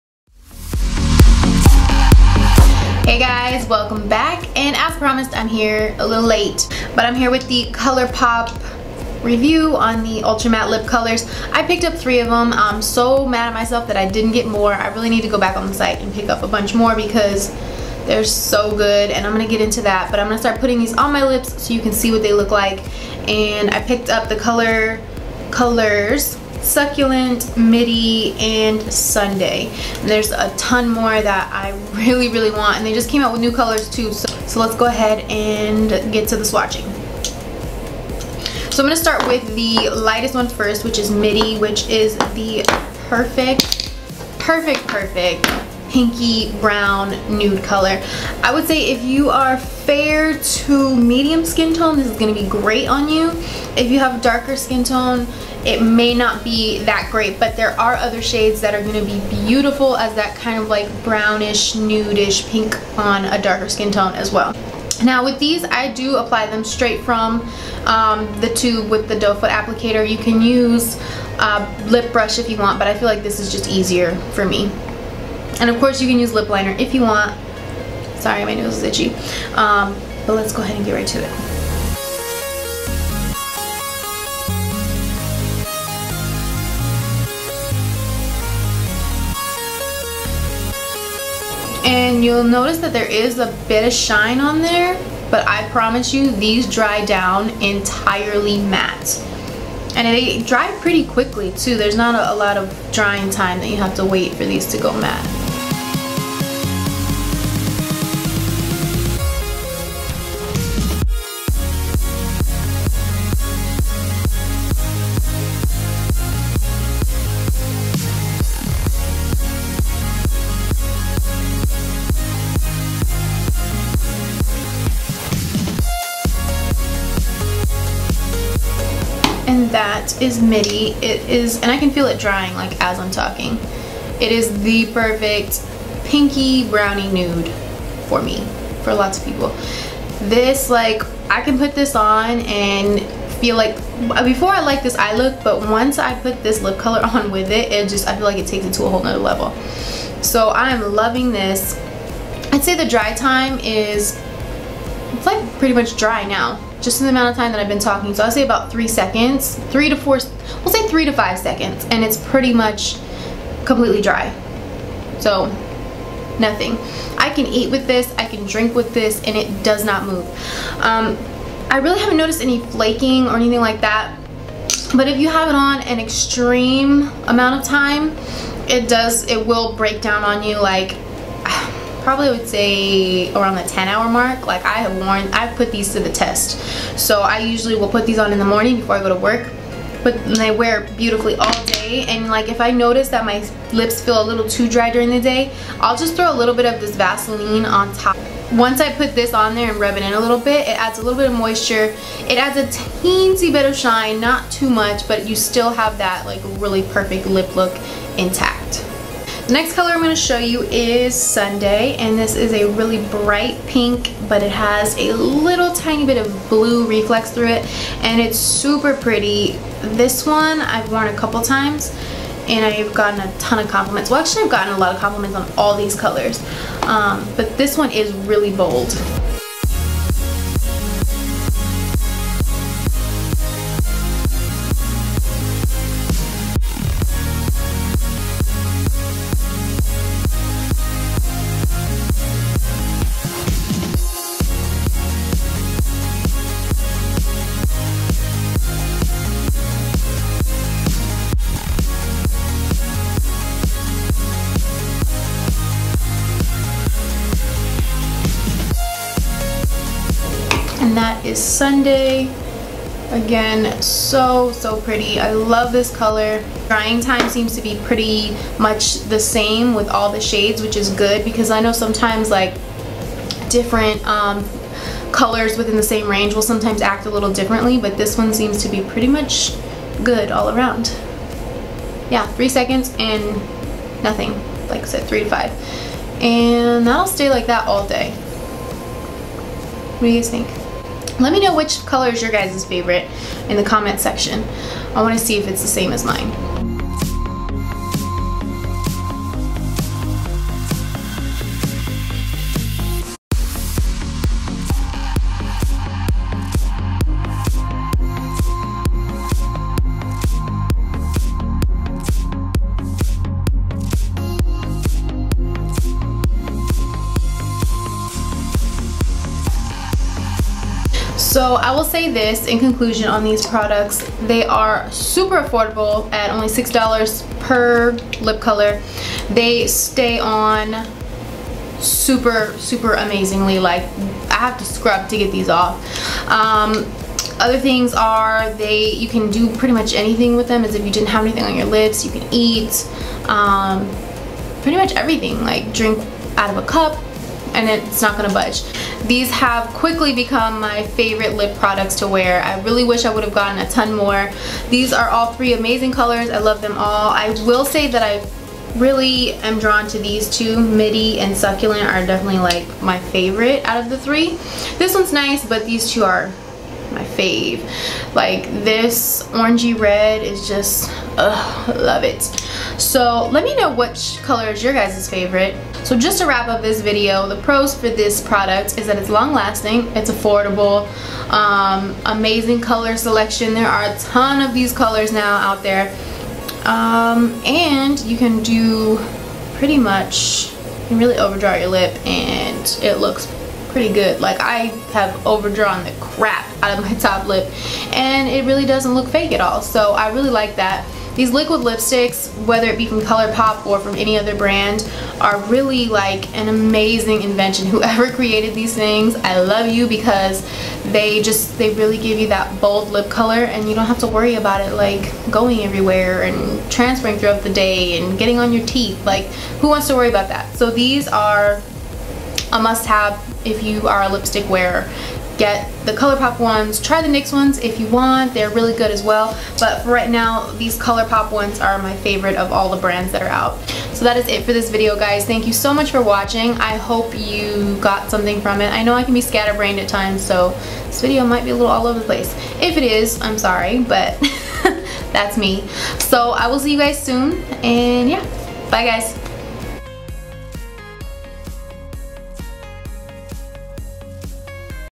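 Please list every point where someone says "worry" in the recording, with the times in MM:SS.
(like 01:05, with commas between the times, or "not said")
06:54, 06:59.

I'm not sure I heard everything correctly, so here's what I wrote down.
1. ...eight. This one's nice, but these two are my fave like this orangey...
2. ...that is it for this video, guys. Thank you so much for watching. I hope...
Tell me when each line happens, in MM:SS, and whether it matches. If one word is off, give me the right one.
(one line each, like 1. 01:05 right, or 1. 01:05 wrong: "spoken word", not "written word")
1. 06:03 wrong: "three", not "eight"
2. 07:14 right.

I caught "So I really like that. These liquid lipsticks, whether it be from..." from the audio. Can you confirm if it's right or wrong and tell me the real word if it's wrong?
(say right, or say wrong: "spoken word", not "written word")
right.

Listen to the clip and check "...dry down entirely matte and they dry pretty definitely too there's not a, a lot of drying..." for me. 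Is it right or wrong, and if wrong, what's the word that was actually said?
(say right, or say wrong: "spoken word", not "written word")
wrong: "quickly", not "definitely".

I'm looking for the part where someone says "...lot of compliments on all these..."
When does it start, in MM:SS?
03:44.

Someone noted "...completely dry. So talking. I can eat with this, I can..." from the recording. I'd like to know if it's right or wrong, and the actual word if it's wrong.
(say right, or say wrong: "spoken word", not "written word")
wrong: "nothing", not "talking".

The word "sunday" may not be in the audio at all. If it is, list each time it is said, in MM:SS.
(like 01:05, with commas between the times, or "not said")
00:28, 03:31, 04:21.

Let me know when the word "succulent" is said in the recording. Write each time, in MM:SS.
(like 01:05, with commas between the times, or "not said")
00:26, 06:01.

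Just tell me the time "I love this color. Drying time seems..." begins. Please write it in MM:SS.
04:25.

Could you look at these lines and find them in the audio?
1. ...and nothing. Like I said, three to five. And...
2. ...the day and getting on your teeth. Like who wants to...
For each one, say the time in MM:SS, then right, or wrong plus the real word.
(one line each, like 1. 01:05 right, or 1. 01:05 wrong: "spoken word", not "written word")
1. 04:42 right
2. 06:57 right.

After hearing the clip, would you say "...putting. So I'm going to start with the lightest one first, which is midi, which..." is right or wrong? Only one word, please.
wrong.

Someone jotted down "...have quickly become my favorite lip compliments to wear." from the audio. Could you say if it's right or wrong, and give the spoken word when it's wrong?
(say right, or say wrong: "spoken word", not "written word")
wrong: "products", not "compliments".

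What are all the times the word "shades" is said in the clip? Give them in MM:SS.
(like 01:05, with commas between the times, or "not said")
00:58, 04:30.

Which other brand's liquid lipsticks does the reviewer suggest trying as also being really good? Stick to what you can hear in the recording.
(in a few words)
NYX.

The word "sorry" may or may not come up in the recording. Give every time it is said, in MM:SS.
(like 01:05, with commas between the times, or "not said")
01:18, 07:23.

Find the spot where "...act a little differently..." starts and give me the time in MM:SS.
04:36.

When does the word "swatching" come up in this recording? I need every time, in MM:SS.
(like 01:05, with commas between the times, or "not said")
00:36.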